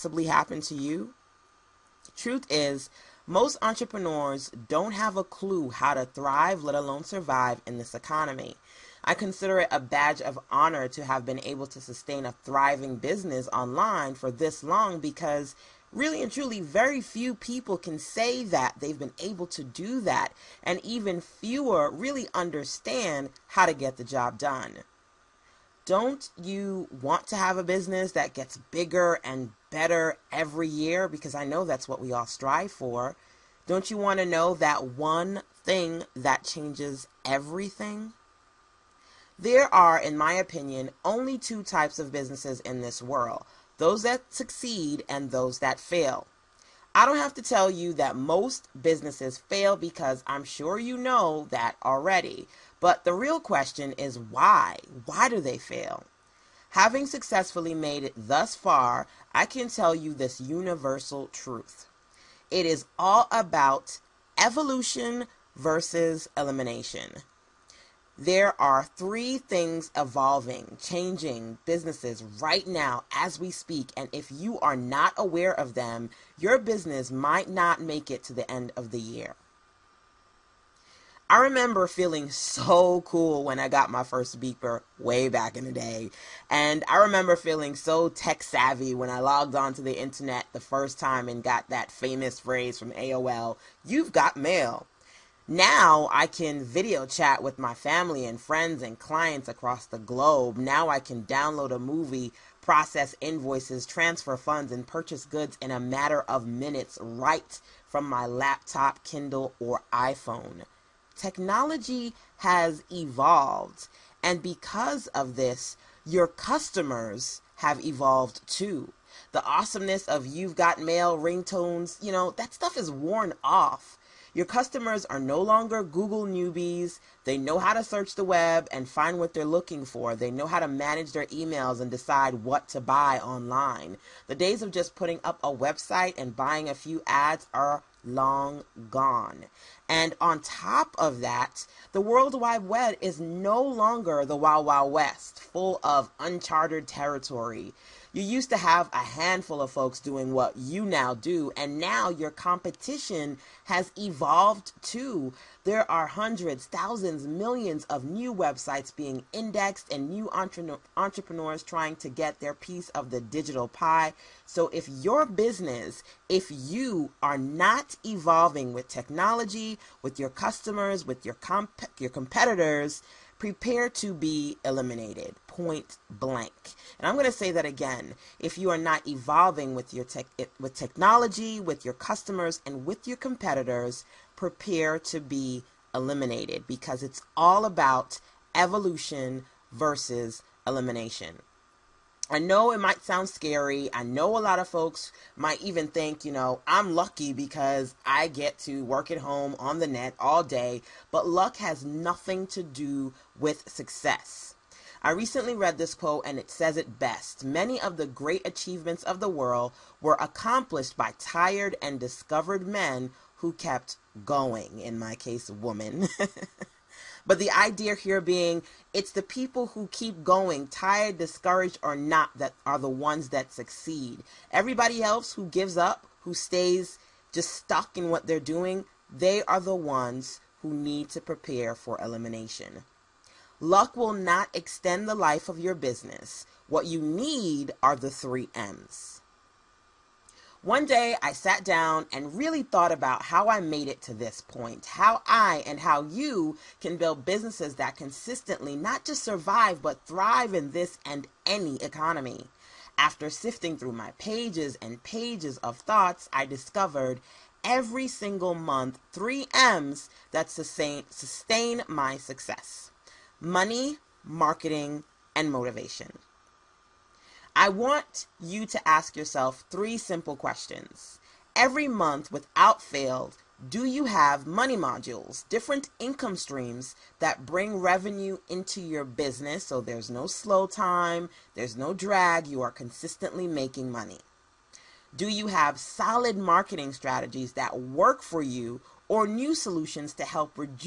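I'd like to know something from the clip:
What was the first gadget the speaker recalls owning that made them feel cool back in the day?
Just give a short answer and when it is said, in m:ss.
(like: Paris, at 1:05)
beeper, at 1:24.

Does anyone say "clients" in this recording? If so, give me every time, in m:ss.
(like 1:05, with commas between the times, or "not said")
1:38.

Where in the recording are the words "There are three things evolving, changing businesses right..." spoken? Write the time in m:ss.
1:08.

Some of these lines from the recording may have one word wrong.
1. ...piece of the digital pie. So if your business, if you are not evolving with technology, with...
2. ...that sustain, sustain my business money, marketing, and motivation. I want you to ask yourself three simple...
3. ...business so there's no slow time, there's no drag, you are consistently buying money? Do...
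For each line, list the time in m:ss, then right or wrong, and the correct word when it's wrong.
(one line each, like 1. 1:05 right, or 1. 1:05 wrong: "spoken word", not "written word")
1. 2:42 right
2. 4:20 wrong: "success", not "business"
3. 4:39 wrong: "making", not "buying".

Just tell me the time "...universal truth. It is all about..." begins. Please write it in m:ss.
1:00.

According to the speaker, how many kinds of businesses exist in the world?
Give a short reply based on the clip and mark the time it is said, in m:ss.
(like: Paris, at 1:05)
2, at 0:41.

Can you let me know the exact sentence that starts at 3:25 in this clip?
I recently read this quote and it says it best.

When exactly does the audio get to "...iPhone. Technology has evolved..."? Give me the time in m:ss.
1:49.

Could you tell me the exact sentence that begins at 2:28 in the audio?
You used to have a handful of folks doing what you now do, and now your competition has evolved too.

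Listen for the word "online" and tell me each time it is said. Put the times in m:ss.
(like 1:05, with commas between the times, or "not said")
0:13, 2:13.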